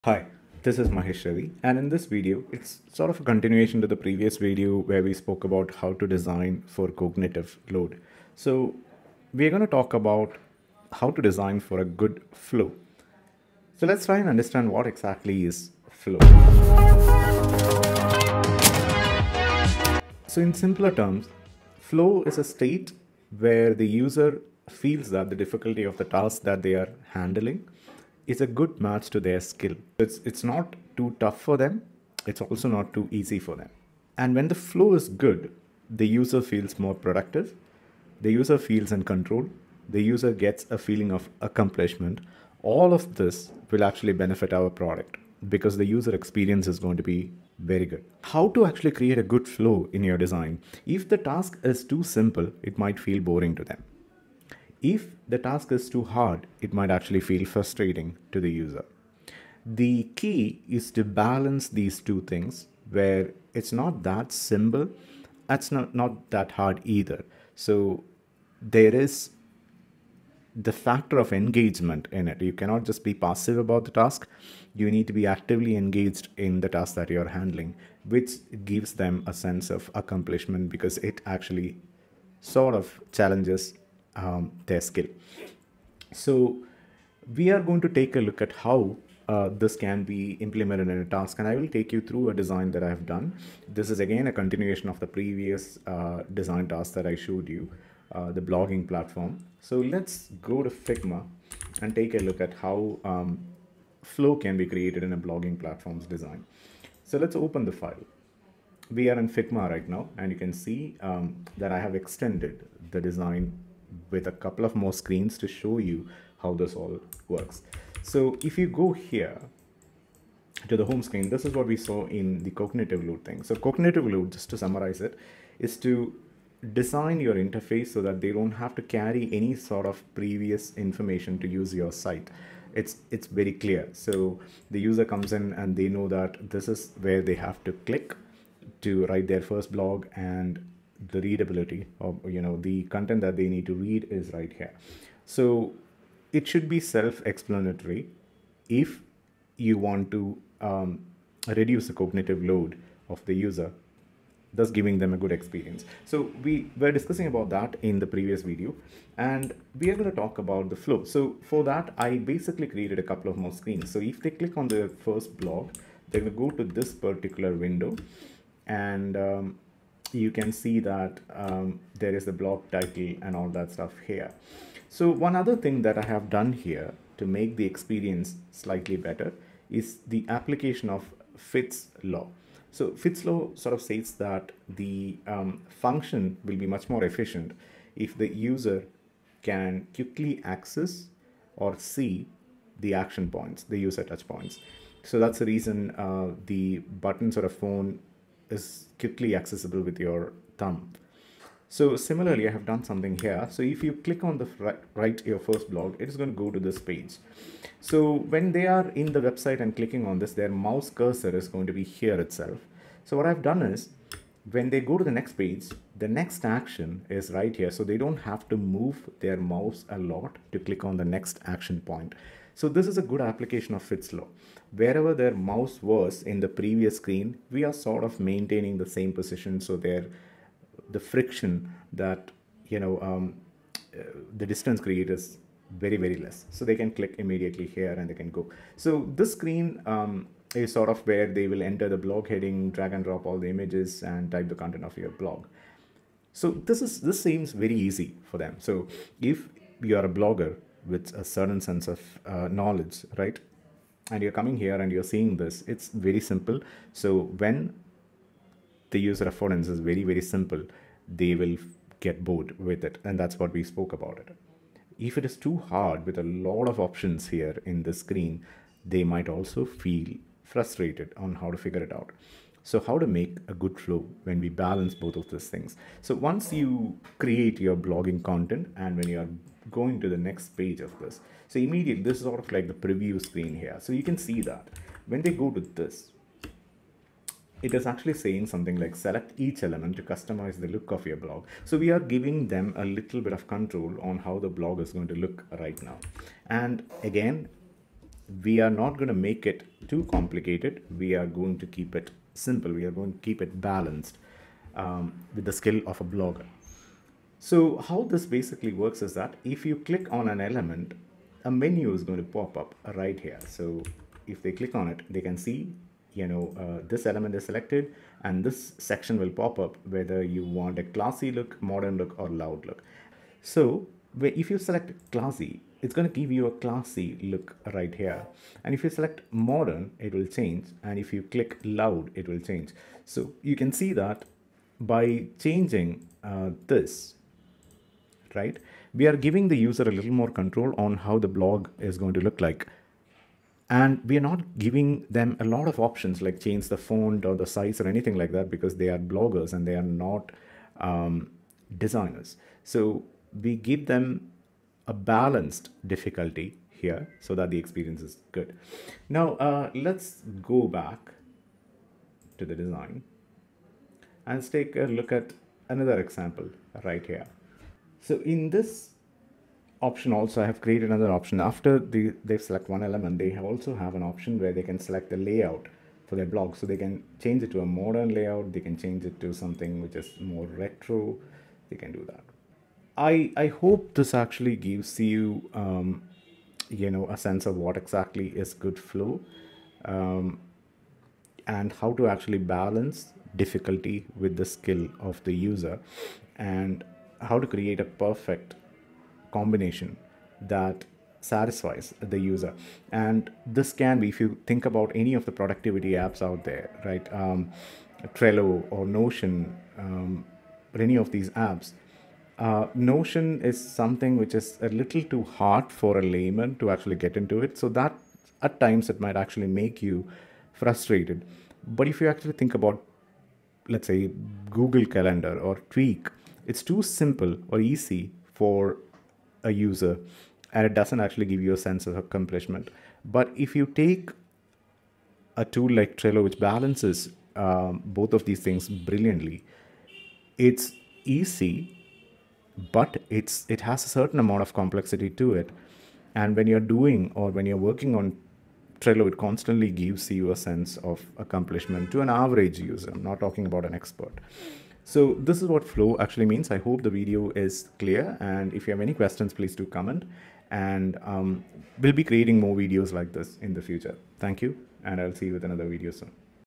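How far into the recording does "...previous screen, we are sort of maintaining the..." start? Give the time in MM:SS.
03:46.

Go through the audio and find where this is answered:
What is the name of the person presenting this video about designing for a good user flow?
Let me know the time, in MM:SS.
00:00.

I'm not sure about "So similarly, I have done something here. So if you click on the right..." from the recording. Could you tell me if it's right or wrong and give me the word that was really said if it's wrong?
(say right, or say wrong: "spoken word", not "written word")
right.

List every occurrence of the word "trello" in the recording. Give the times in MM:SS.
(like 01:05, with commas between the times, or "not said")
06:48, 07:15, 07:28.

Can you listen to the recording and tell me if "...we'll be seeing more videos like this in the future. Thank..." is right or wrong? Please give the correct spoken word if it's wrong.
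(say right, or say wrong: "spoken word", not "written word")
wrong: "creating", not "seeing".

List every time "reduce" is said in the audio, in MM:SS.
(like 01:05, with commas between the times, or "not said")
02:31.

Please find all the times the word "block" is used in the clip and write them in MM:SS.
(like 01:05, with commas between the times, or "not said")
02:45, 02:52.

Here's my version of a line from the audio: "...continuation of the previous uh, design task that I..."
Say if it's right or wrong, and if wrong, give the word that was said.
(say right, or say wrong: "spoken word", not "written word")
right.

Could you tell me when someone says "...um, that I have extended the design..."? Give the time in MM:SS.
01:50.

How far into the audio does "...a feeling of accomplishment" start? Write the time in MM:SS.
00:40.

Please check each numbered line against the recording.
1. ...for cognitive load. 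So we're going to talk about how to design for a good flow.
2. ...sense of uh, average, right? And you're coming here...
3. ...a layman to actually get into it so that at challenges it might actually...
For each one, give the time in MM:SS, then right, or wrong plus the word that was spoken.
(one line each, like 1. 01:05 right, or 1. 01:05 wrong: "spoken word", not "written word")
1. 00:06 right
2. 04:11 wrong: "knowledge", not "average"
3. 06:55 wrong: "times", not "challenges".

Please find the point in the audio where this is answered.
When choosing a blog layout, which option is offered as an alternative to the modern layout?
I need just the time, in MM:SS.
06:20.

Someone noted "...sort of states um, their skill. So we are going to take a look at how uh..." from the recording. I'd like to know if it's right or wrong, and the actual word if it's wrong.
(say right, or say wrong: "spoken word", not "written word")
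wrong: "challenges", not "states".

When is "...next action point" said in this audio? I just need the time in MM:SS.
03:41.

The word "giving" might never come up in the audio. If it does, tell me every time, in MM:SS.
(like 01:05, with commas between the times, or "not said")
02:34, 04:51, 05:39, 05:44.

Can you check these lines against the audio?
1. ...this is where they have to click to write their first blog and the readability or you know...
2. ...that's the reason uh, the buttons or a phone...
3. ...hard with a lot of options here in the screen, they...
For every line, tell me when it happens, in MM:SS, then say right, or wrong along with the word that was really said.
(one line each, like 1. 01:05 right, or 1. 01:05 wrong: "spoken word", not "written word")
1. 02:16 right
2. 03:15 right
3. 04:25 right.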